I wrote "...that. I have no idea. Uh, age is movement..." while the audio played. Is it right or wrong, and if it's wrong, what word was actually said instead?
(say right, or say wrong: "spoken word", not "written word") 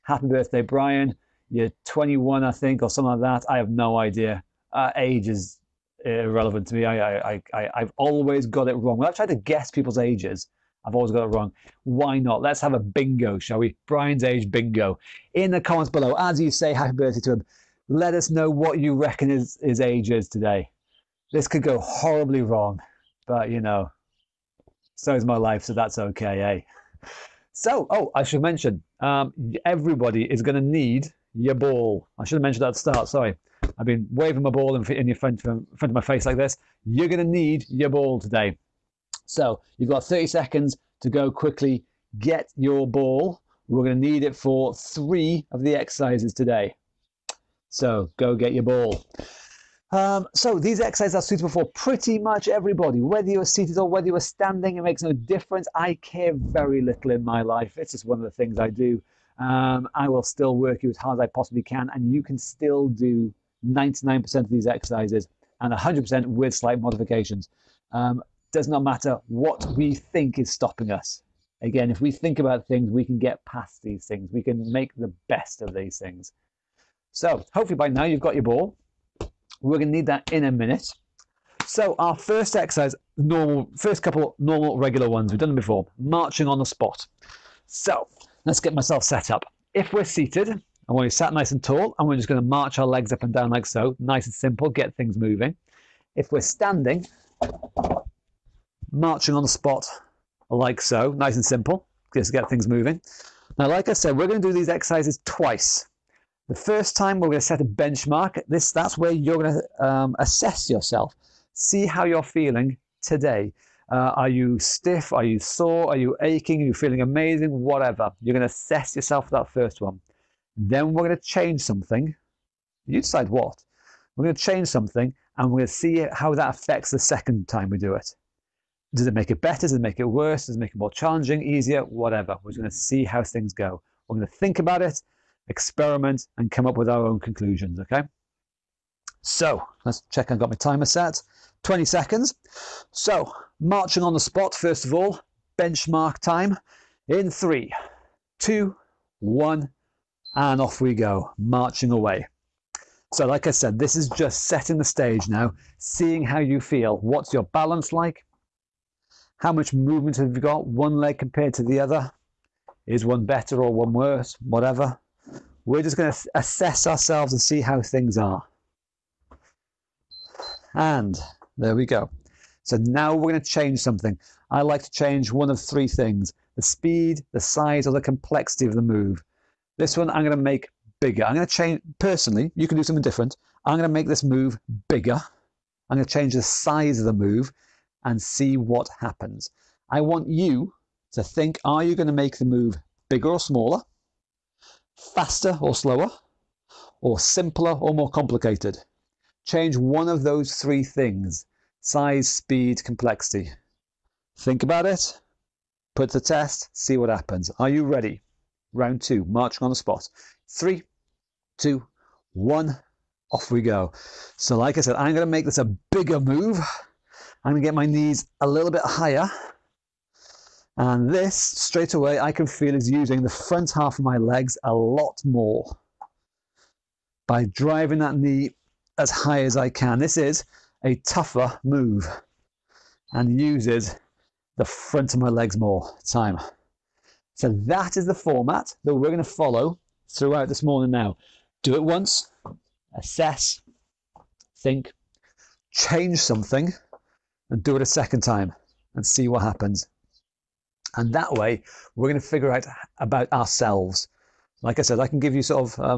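wrong: "irrelevant", not "movement".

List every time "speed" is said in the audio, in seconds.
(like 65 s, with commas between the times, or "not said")
176 s, 202 s.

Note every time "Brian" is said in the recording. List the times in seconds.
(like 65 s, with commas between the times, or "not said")
0 s, 13 s.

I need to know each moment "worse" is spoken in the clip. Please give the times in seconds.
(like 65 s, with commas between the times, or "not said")
130 s, 163 s.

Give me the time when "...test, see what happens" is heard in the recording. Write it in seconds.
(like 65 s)
206 s.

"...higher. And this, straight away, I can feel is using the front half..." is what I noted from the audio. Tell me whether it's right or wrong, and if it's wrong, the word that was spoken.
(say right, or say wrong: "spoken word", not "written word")
right.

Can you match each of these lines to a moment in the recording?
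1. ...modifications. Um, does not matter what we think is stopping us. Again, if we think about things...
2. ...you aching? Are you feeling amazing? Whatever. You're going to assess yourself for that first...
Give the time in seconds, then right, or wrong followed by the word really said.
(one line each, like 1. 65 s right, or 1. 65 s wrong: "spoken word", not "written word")
1. 66 s right
2. 115 s right.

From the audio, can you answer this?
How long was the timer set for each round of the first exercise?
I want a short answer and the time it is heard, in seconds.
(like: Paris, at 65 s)
20 seconds, at 141 s.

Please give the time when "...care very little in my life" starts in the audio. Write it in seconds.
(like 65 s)
56 s.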